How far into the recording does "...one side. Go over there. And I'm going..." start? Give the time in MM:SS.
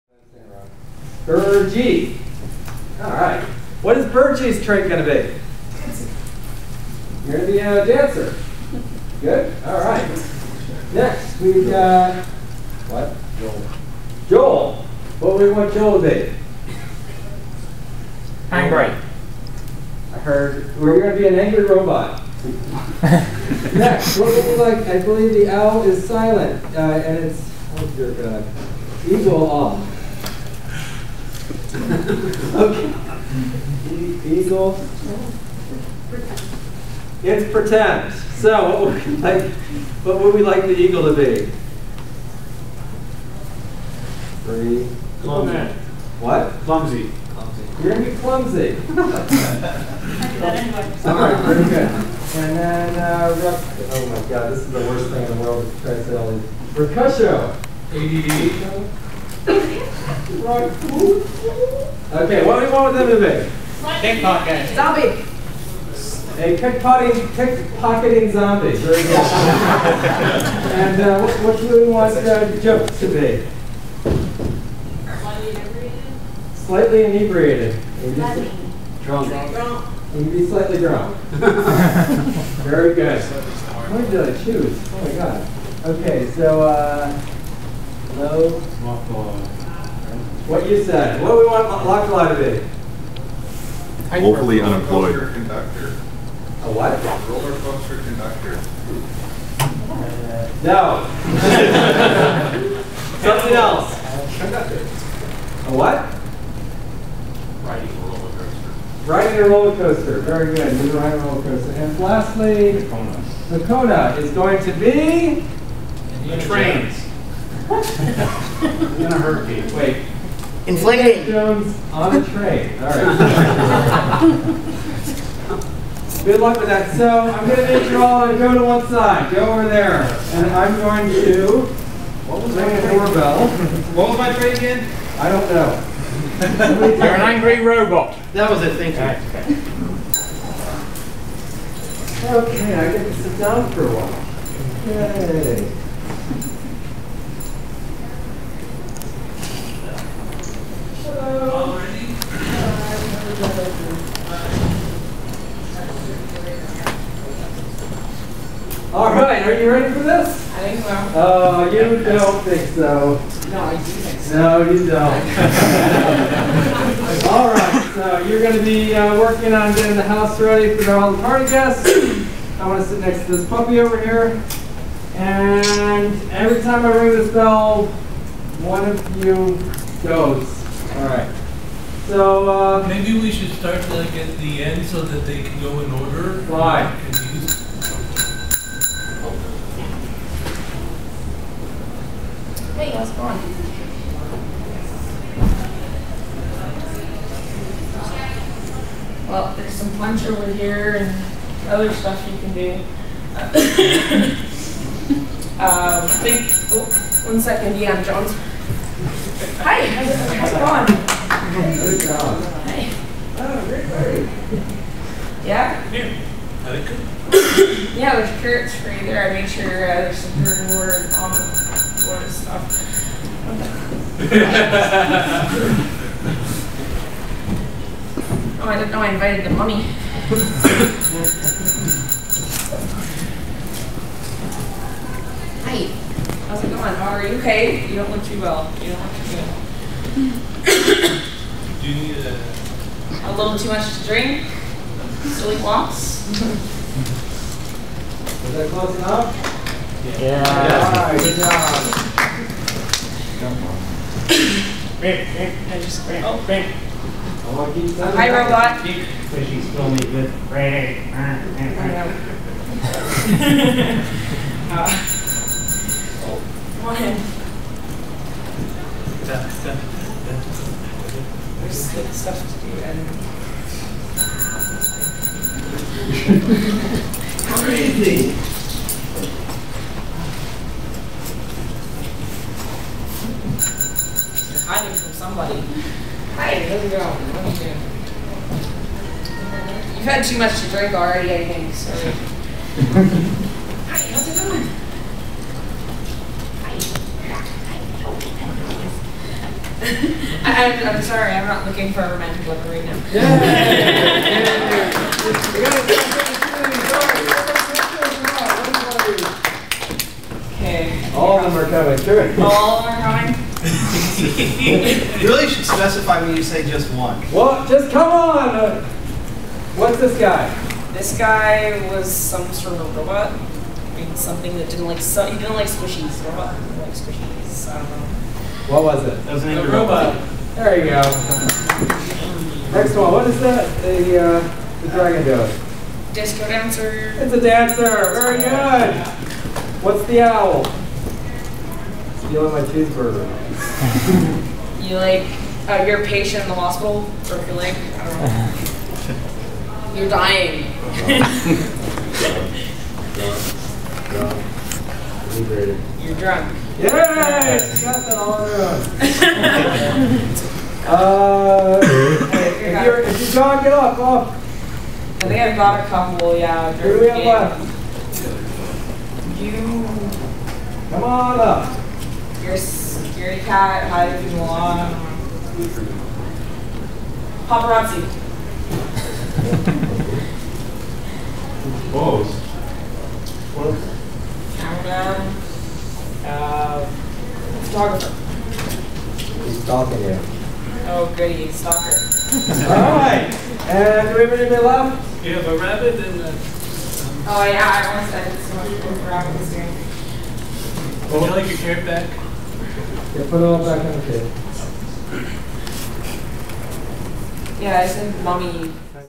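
02:08.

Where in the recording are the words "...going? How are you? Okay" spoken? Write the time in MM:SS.
03:56.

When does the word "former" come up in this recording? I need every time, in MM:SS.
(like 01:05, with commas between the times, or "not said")
not said.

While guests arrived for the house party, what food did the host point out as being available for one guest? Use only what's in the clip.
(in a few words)
carrots.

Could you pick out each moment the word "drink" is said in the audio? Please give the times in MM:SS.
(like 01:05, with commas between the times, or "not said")
04:04, 04:50.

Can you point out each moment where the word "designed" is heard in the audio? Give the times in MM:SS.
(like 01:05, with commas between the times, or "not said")
not said.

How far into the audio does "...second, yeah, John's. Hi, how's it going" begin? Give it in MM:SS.
03:27.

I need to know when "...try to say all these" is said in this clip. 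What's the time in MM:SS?
00:55.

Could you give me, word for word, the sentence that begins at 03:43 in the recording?
Oh, I didn't know I invited the mummy.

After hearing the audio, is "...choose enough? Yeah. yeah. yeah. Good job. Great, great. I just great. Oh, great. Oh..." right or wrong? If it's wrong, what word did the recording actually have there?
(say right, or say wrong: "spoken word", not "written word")
wrong: "close", not "choose".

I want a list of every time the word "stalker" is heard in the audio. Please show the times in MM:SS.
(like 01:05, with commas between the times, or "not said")
06:31.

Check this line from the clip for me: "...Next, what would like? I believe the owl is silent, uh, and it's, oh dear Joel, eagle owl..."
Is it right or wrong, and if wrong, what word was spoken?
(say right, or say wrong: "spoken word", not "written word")
wrong: "God", not "Joel".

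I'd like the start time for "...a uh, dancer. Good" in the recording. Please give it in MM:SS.
00:07.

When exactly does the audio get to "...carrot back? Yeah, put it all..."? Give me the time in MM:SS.
06:41.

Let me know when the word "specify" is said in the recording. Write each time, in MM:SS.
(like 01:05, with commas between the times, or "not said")
05:15.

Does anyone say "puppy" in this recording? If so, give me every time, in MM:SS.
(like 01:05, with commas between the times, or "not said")
02:53.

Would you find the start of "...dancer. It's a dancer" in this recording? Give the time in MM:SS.
05:36.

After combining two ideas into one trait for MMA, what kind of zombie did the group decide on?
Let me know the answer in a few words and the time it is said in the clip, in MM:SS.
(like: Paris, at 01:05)
pickpocketing zombie, at 01:07.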